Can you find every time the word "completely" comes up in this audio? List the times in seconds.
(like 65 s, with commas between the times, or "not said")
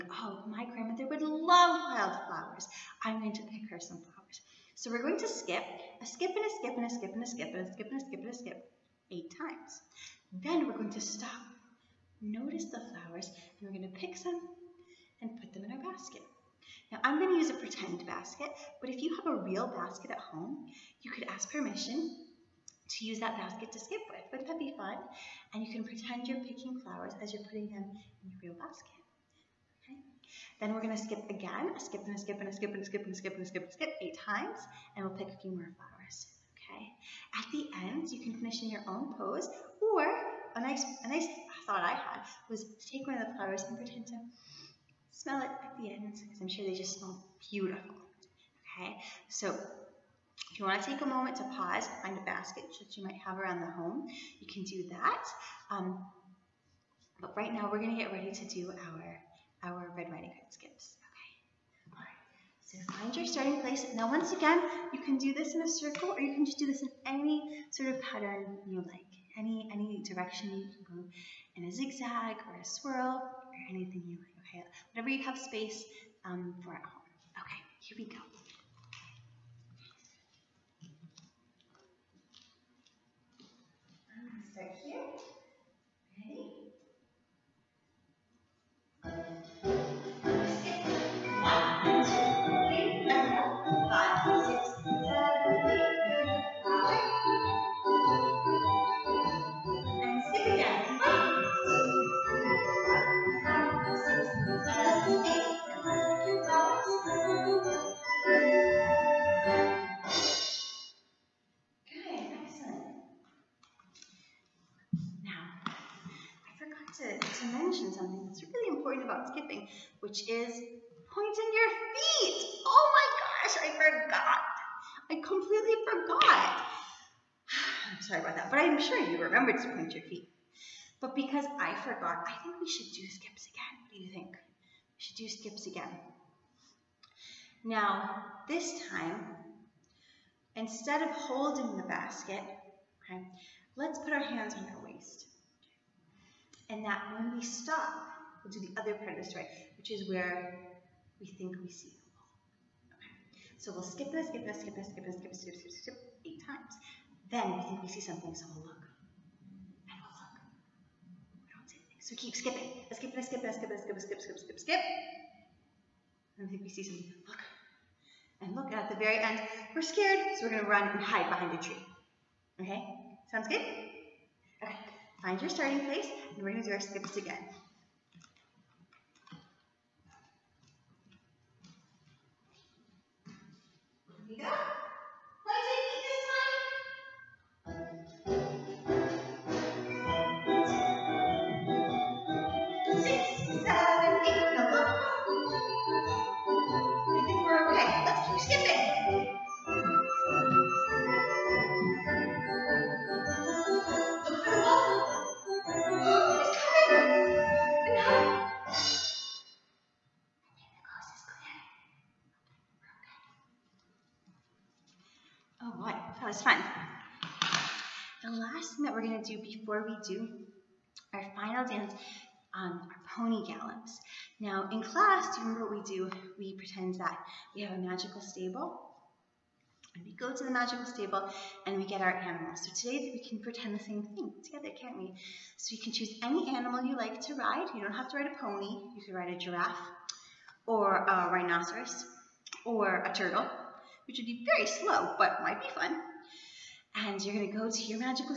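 125 s.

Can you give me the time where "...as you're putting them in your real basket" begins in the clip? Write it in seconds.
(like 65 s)
27 s.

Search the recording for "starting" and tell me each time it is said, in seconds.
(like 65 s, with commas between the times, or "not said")
63 s, 175 s.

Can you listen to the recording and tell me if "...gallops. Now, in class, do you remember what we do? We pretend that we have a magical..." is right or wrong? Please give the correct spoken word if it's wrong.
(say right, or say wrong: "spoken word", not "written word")
right.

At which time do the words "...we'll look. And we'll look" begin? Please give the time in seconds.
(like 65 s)
158 s.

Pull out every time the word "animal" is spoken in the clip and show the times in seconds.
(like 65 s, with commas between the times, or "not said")
232 s, 236 s.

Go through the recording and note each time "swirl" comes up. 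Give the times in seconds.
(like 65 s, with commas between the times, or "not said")
72 s.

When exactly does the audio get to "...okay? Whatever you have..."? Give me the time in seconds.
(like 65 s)
74 s.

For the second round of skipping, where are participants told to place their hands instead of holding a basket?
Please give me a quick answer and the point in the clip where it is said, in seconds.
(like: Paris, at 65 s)
On our waist, at 144 s.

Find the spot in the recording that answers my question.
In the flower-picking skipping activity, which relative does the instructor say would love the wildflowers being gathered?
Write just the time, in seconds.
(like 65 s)
0 s.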